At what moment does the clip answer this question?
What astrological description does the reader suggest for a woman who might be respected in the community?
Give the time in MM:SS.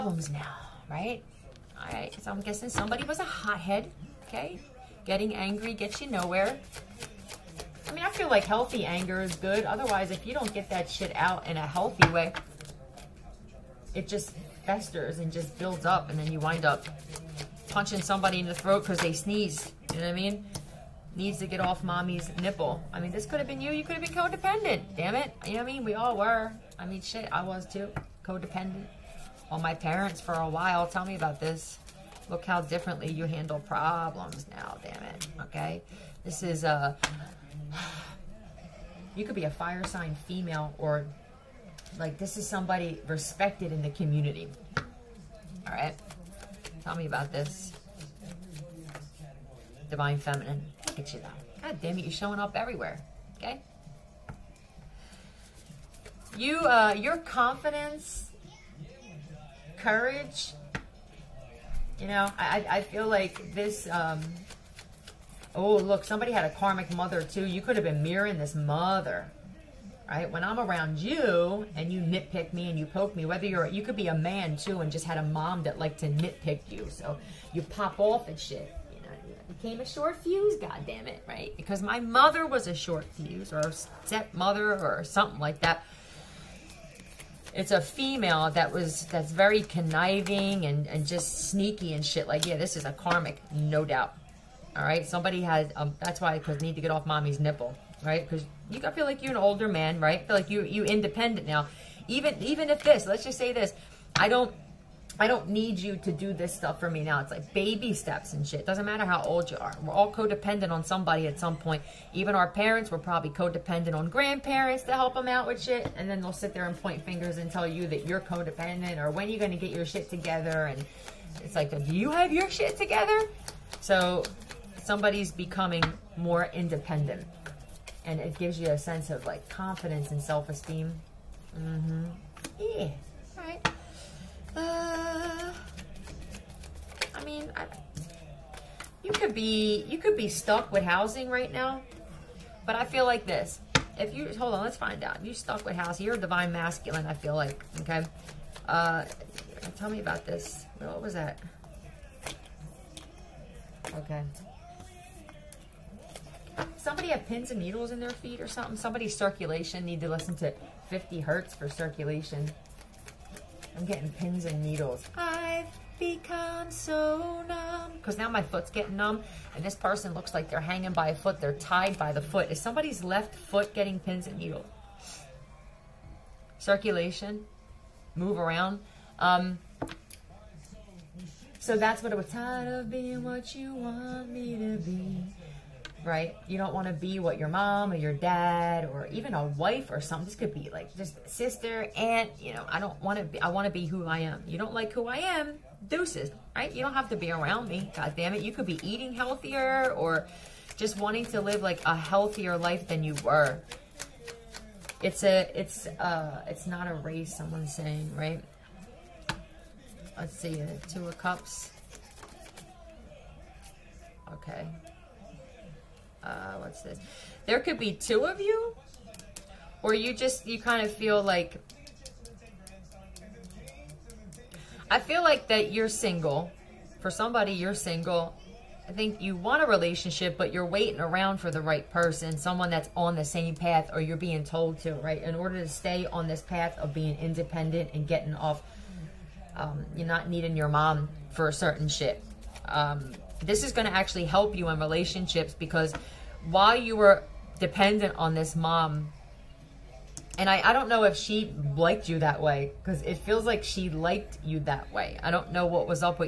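00:39.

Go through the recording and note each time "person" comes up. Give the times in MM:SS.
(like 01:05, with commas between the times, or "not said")
02:49, 03:51.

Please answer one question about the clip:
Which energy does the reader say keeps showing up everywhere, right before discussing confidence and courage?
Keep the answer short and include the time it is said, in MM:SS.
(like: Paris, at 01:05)
Divine Feminine, at 00:49.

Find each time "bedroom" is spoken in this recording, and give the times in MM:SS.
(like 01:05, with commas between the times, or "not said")
not said.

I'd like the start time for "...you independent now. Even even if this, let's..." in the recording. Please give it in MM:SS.
01:40.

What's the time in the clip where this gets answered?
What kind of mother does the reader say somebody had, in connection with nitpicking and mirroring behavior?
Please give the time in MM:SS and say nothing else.
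01:06.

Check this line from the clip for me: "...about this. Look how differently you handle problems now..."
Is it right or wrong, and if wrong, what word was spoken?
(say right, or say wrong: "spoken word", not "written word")
right.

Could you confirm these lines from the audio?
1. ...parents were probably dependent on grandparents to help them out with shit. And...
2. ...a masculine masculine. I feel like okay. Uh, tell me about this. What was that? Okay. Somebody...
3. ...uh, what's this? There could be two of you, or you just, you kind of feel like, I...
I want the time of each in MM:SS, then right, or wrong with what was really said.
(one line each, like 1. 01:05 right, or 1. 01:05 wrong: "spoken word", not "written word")
1. 01:52 wrong: "codependent", not "dependent"
2. 02:26 wrong: "divine", not "masculine"
3. 03:36 right.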